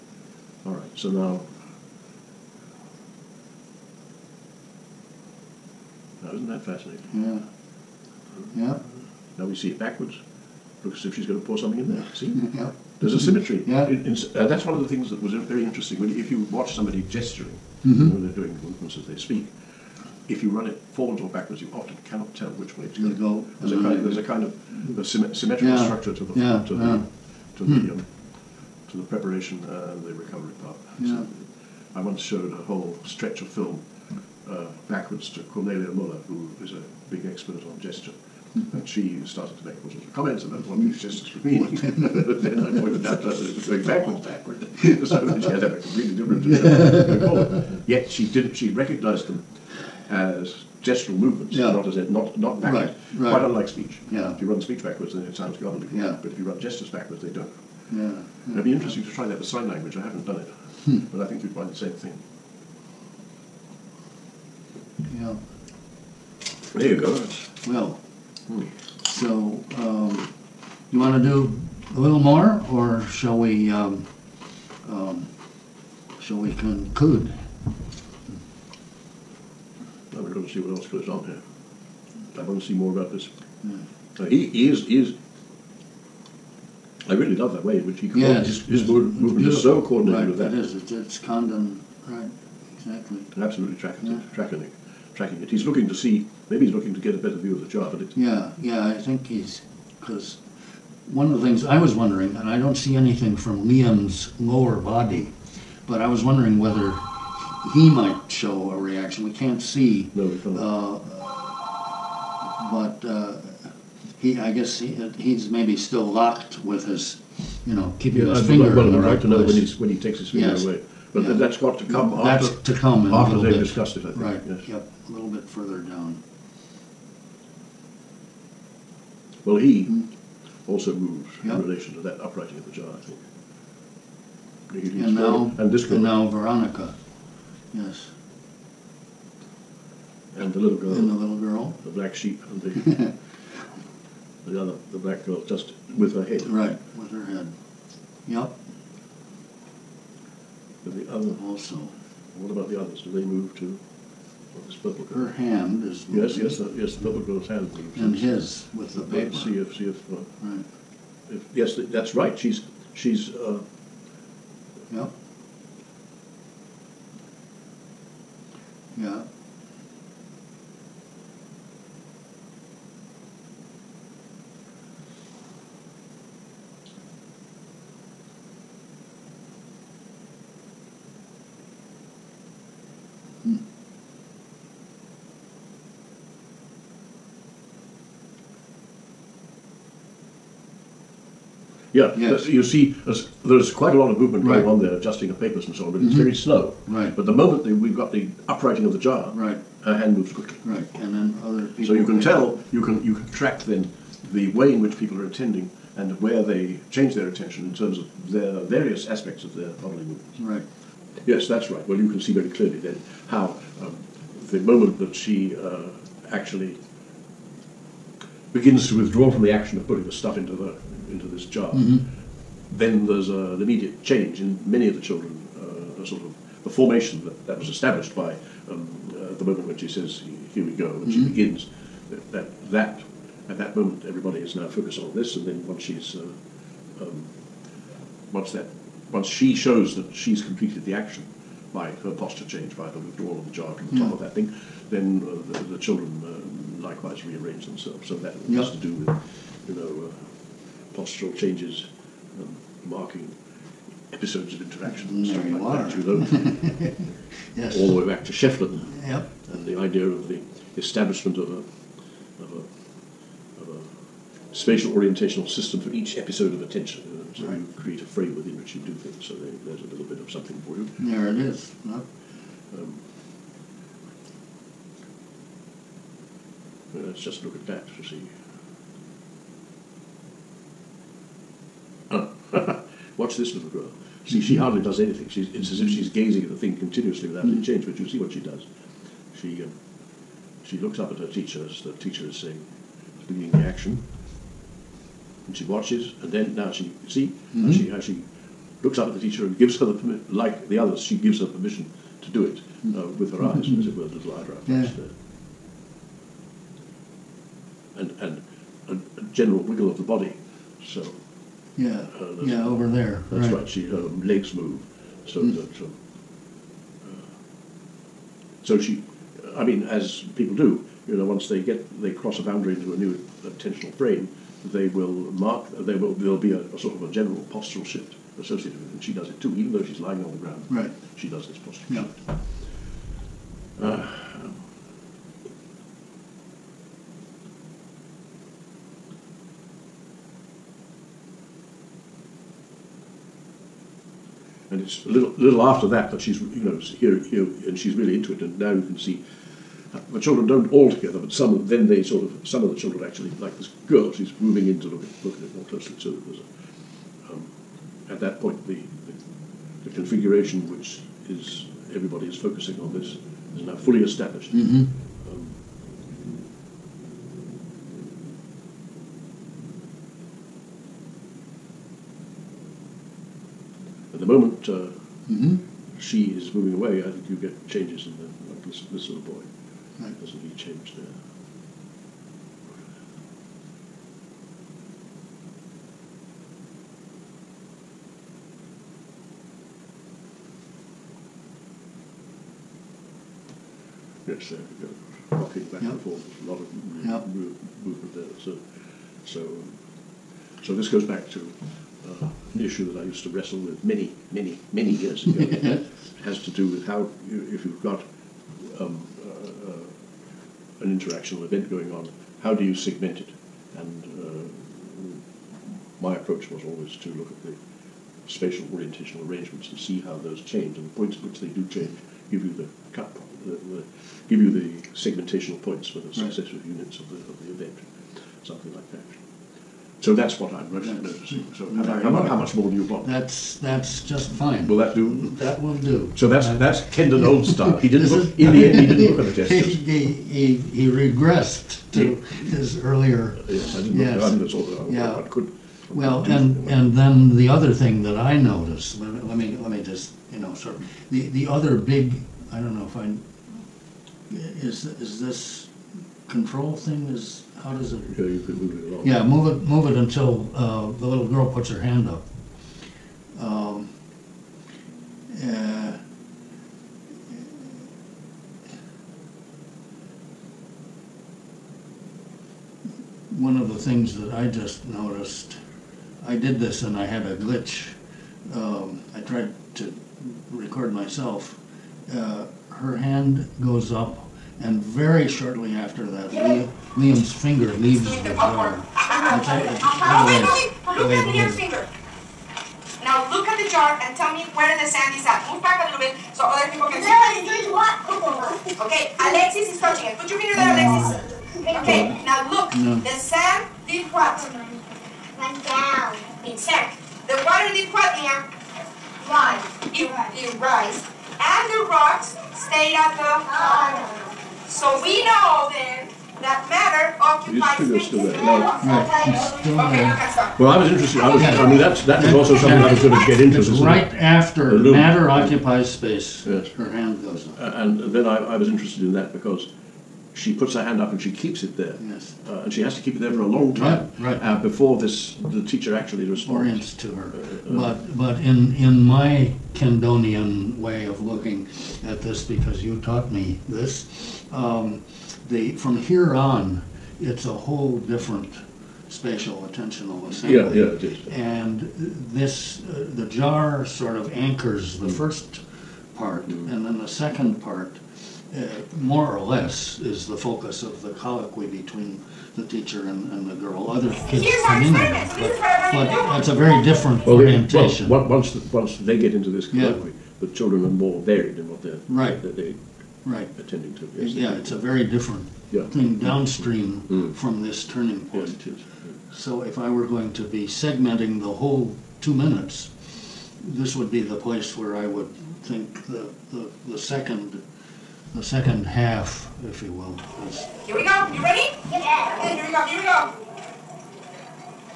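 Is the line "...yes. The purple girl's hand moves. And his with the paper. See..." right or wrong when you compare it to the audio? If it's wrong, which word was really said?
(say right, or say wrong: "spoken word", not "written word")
right.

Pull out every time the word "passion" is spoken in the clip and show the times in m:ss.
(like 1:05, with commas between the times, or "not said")
not said.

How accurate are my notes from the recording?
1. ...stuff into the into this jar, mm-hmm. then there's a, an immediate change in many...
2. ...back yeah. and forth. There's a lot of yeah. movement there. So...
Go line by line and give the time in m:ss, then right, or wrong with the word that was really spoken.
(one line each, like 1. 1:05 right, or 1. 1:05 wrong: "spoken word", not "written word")
1. 3:40 right
2. 6:35 right.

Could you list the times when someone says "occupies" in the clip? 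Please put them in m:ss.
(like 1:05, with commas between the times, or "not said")
8:37, 8:45.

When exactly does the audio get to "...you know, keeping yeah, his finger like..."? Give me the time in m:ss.
1:57.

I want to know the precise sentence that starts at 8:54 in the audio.
Uh, before this the teacher actually responds.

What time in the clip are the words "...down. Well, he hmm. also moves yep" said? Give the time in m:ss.
2:05.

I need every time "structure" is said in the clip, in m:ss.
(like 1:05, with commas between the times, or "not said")
0:25.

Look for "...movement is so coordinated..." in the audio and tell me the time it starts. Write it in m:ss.
1:28.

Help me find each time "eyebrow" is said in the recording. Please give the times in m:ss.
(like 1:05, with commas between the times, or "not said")
5:04.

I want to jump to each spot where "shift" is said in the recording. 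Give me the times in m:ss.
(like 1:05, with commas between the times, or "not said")
5:27, 5:32.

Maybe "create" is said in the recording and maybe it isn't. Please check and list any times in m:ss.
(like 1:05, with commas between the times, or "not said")
4:27.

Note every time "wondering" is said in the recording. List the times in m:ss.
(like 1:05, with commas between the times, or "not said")
1:41, 1:46.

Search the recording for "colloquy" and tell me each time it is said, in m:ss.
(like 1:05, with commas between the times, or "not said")
9:21, 9:29.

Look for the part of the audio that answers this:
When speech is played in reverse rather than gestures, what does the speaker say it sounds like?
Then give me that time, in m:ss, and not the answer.
0:55.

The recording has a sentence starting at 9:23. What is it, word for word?
Other kids come in, but, but it's a very different well, orientation.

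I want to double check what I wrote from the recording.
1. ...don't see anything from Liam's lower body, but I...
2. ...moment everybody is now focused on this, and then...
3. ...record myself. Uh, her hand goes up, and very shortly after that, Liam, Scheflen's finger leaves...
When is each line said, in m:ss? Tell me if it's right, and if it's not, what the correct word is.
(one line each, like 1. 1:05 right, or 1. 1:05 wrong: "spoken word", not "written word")
1. 1:42 right
2. 3:53 right
3. 8:00 wrong: "Liam", not "Scheflen".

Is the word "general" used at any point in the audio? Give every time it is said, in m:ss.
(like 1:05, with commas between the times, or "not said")
5:09, 5:27.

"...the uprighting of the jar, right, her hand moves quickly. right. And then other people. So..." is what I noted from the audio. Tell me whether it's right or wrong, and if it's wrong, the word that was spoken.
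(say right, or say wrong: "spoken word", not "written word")
right.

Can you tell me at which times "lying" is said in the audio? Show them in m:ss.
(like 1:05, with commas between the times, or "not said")
5:29.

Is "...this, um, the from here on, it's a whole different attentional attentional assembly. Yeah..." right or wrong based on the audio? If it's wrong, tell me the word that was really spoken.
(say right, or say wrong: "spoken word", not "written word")
wrong: "spatial", not "attentional".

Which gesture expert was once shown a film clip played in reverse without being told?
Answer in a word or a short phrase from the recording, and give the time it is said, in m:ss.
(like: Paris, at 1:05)
Cornelia Muller, at 0:35.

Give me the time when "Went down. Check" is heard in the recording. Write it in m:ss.
8:25.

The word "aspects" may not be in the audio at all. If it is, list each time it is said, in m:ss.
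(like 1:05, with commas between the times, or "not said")
3:29.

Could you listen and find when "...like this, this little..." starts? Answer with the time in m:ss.
6:18.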